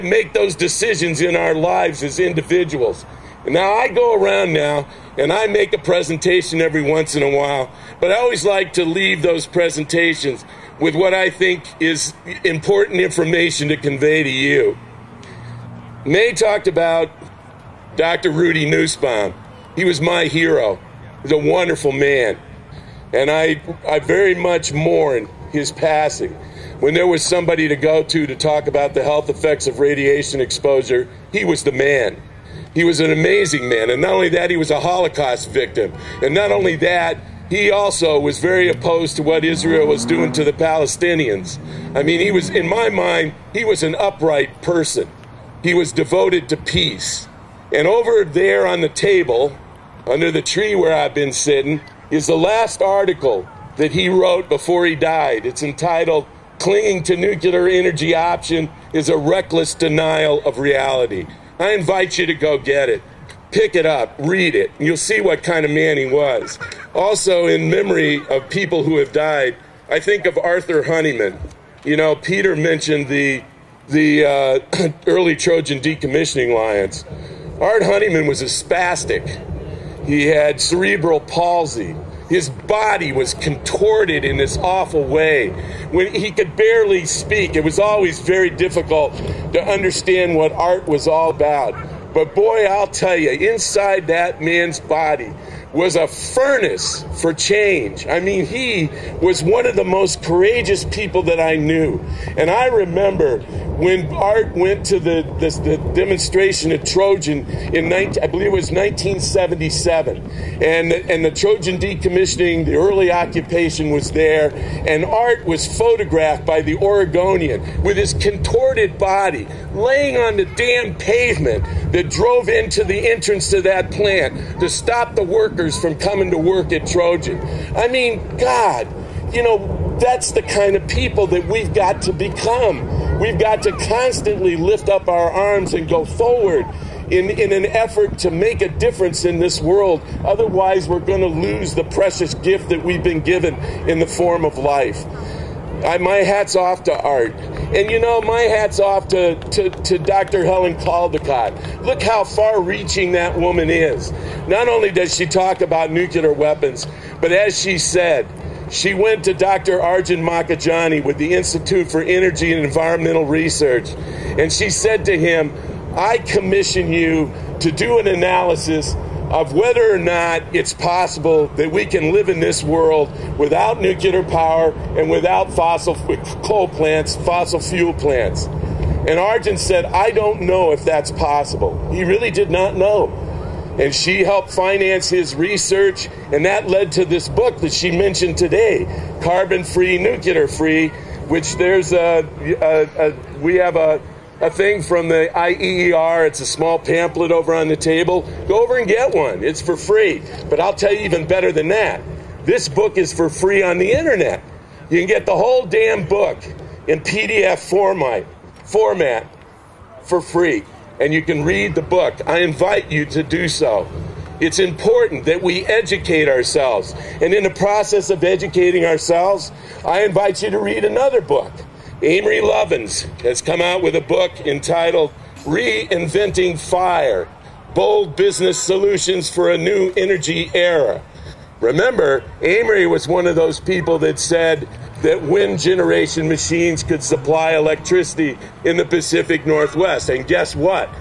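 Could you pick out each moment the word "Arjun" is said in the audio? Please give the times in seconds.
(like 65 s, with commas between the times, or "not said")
159 s, 179 s.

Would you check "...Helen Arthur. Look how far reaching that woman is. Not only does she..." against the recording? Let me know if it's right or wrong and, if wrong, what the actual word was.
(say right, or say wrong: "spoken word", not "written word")
wrong: "Caldicott", not "Arthur".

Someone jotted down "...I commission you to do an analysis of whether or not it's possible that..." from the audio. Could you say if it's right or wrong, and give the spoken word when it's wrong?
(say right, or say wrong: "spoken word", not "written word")
right.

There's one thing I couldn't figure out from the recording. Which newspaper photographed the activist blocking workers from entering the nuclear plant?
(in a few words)
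The Oregonian.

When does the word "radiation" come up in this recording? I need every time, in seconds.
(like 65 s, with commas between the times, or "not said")
29 s.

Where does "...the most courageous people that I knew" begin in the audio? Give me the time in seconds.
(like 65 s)
99 s.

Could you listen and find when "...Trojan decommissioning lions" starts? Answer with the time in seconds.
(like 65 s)
75 s.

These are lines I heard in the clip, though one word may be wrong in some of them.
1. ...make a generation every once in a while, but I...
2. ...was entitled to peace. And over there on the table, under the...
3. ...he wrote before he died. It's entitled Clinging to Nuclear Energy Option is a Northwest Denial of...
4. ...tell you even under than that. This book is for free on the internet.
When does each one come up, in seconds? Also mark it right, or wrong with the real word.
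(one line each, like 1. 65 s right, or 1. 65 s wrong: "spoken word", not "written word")
1. 5 s wrong: "presentation", not "generation"
2. 45 s wrong: "devoted", not "entitled"
3. 53 s wrong: "Reckless", not "Northwest"
4. 200 s wrong: "better", not "under".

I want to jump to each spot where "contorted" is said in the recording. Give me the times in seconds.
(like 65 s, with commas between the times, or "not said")
83 s, 118 s.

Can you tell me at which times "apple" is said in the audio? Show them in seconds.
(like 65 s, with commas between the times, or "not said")
not said.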